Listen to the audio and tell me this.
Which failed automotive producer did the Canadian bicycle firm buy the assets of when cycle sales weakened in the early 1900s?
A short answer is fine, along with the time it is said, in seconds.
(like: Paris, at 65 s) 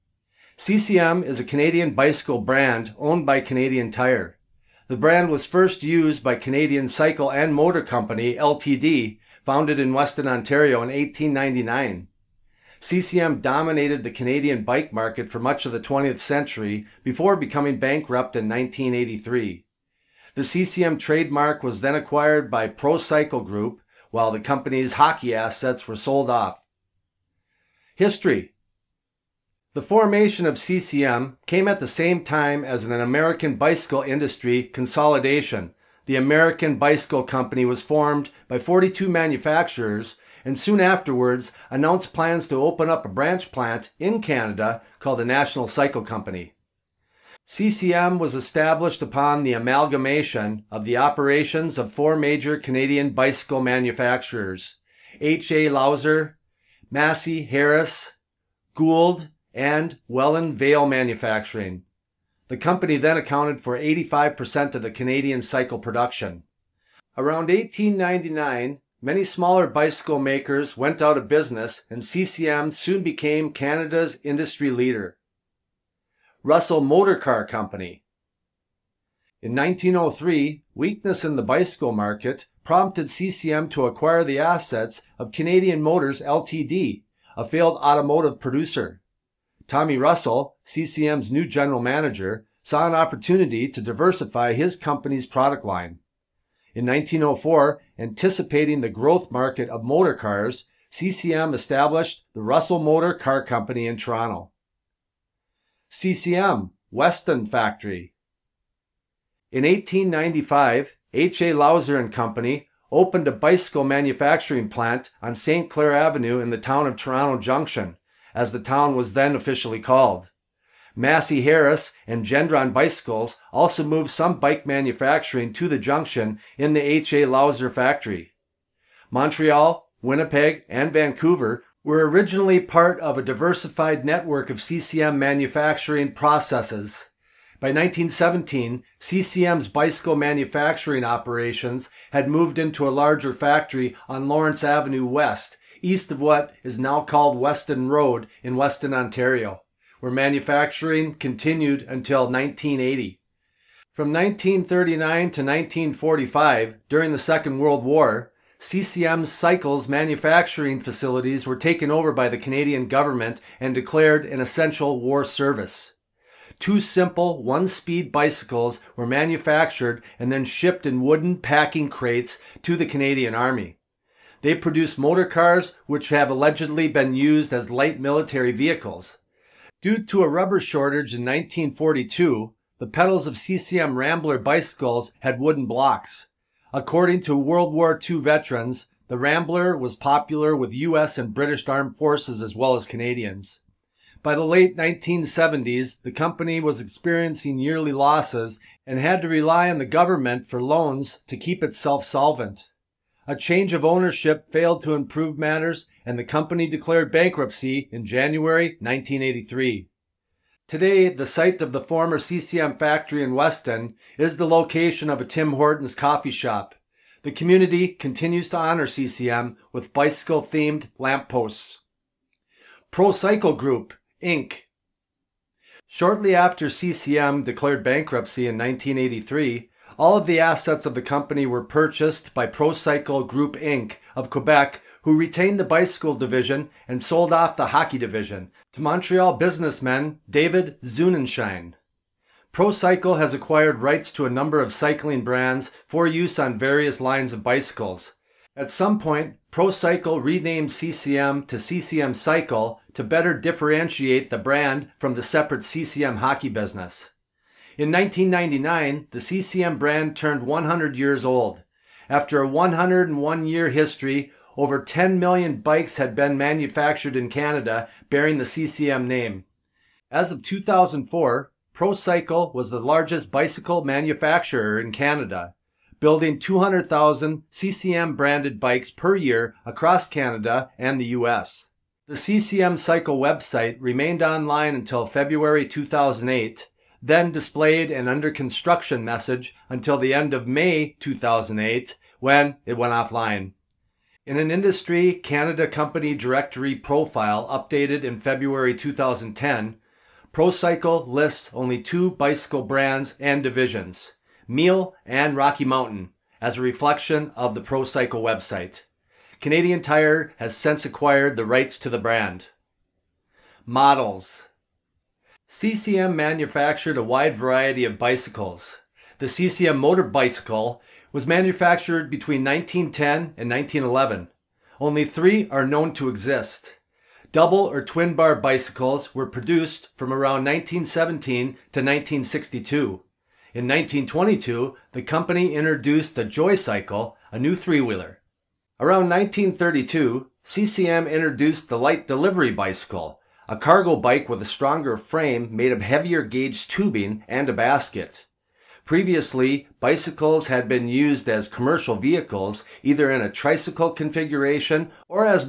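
Canadian Motors LTD, at 85 s.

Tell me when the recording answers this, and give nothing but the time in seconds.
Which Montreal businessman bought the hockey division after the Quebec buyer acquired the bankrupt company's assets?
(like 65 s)
240 s.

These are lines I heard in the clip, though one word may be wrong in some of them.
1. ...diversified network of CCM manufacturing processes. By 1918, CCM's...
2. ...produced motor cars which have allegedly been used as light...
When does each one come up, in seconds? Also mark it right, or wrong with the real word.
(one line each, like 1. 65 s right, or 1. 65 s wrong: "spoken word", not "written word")
1. 133 s wrong: "1917", not "1918"
2. 174 s right.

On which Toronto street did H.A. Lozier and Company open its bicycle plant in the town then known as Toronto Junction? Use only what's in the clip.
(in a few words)
St. Clair Avenue.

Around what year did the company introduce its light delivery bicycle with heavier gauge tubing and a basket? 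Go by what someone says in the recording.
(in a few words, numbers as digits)
1932.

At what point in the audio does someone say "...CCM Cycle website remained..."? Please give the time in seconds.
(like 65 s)
282 s.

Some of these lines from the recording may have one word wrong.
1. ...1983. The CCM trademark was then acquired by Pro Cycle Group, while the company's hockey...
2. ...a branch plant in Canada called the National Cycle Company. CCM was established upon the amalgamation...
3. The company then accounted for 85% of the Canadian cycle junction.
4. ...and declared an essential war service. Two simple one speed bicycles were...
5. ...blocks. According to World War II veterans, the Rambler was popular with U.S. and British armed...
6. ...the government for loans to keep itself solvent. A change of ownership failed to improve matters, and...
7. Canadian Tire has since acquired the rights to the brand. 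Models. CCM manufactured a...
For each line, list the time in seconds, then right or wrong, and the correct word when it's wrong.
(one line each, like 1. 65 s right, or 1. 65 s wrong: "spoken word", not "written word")
1. 18 s right
2. 43 s right
3. 62 s wrong: "production", not "junction"
4. 163 s right
5. 185 s right
6. 199 s right
7. 309 s right.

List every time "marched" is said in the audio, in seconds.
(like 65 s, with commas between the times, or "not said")
not said.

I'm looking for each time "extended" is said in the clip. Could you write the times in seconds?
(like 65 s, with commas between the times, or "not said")
not said.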